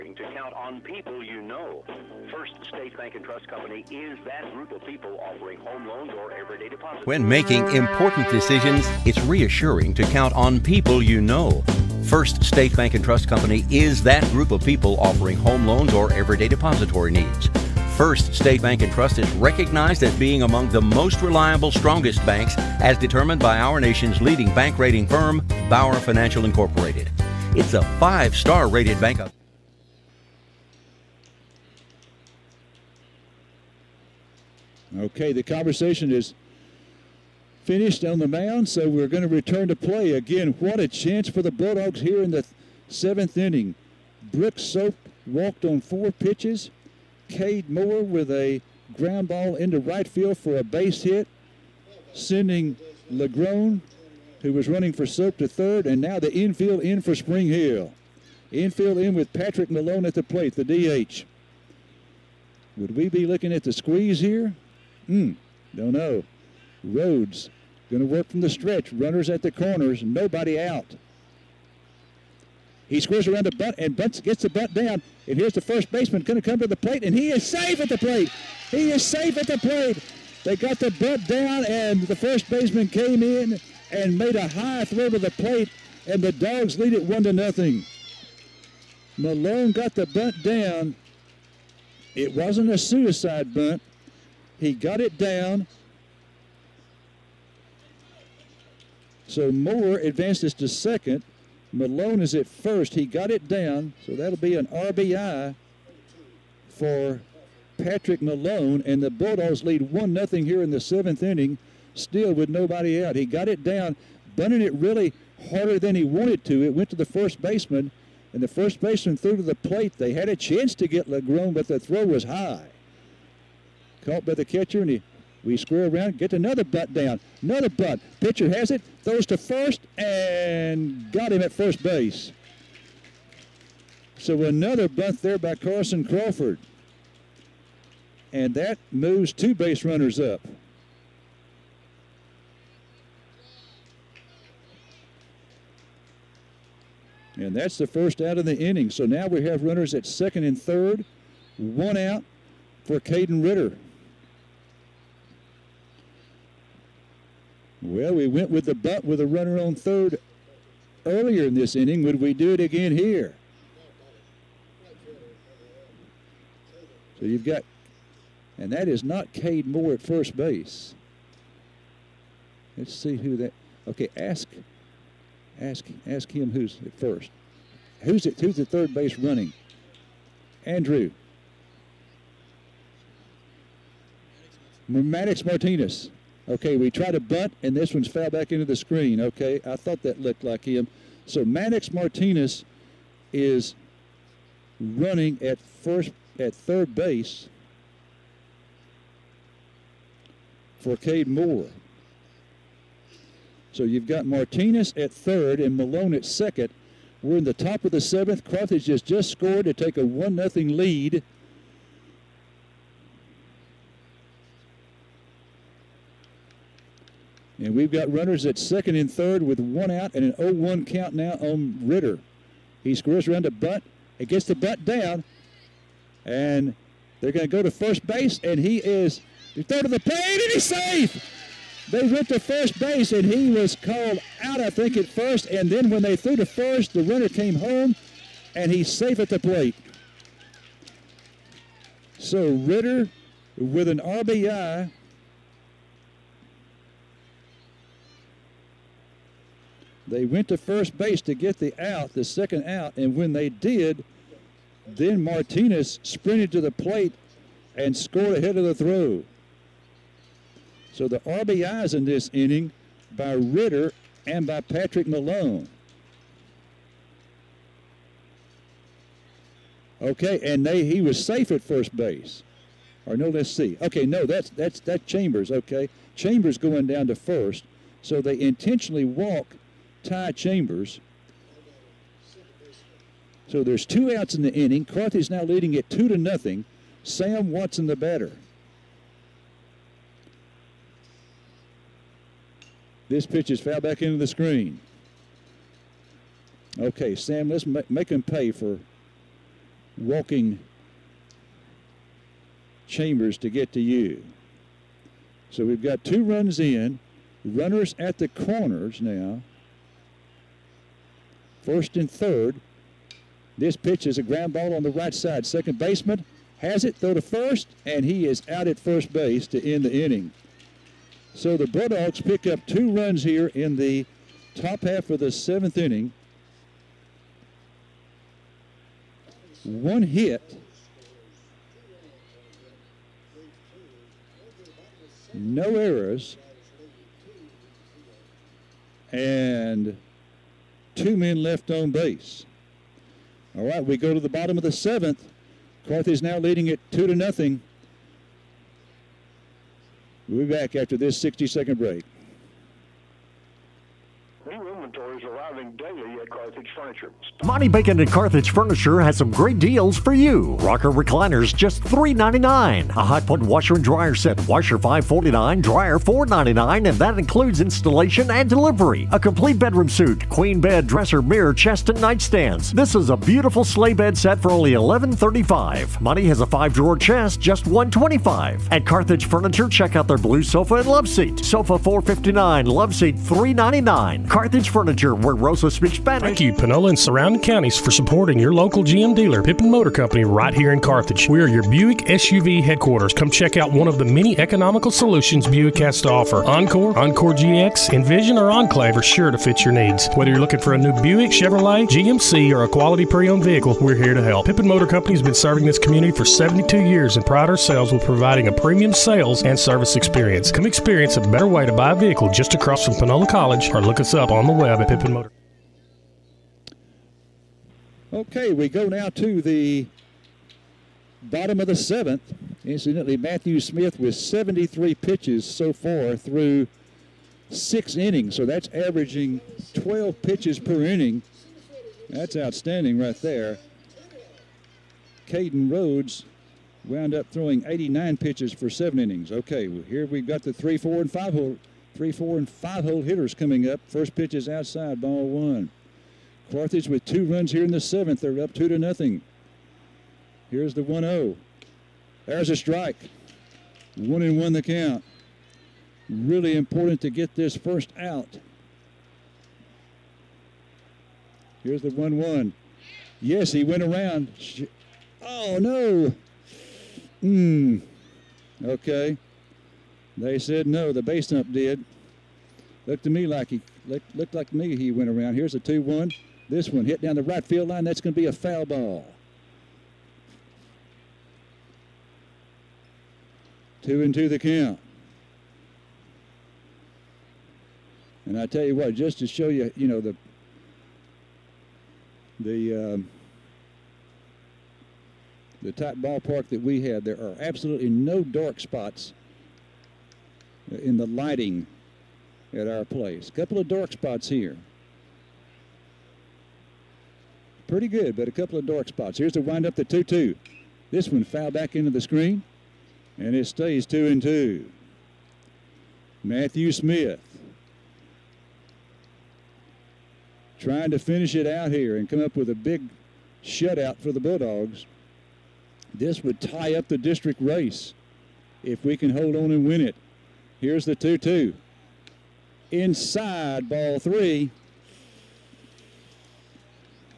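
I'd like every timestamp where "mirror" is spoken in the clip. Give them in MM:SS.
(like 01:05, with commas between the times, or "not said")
06:11.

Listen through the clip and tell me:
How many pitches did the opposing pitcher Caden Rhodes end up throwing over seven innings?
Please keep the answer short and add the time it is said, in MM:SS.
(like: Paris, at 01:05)
89, at 07:17.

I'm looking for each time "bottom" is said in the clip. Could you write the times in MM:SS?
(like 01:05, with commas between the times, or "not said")
05:44, 07:01.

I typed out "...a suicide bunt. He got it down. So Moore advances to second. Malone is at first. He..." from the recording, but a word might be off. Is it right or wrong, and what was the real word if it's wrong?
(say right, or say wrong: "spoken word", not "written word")
right.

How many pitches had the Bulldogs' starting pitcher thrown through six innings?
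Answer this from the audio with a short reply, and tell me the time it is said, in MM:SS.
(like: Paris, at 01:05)
73, at 07:04.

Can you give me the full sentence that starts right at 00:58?
Infield in with Patrick Malone at the plate, the DH.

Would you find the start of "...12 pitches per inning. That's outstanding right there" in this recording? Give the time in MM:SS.
07:09.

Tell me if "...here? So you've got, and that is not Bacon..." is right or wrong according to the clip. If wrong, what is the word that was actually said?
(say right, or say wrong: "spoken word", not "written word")
wrong: "Cade", not "Bacon".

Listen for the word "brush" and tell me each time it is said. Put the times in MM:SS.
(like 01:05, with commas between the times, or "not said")
not said.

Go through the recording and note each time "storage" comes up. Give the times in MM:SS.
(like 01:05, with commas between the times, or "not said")
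not said.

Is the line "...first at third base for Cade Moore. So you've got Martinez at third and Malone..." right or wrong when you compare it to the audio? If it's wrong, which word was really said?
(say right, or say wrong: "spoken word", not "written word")
right.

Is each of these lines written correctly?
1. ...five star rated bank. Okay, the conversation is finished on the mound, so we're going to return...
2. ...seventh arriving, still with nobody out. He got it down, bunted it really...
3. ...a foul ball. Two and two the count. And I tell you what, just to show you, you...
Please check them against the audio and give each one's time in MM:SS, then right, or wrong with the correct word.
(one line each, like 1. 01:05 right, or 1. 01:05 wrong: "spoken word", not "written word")
1. 00:27 right
2. 01:50 wrong: "inning", not "arriving"
3. 07:58 right.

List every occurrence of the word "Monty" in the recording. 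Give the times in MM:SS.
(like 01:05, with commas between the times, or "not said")
05:57, 06:15.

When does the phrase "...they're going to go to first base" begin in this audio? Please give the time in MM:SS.
03:47.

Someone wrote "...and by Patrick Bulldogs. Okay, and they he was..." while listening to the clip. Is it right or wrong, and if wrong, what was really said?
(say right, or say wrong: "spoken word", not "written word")
wrong: "Malone", not "Bulldogs".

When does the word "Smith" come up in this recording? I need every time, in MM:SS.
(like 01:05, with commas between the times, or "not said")
07:03, 08:36.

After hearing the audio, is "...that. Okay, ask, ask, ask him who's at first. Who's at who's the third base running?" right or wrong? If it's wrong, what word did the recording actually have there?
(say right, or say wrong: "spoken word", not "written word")
right.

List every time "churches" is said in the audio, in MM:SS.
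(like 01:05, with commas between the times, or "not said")
not said.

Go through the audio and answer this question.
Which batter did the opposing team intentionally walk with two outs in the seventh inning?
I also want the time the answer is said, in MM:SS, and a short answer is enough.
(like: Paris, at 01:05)
Ty Chambers, at 04:40.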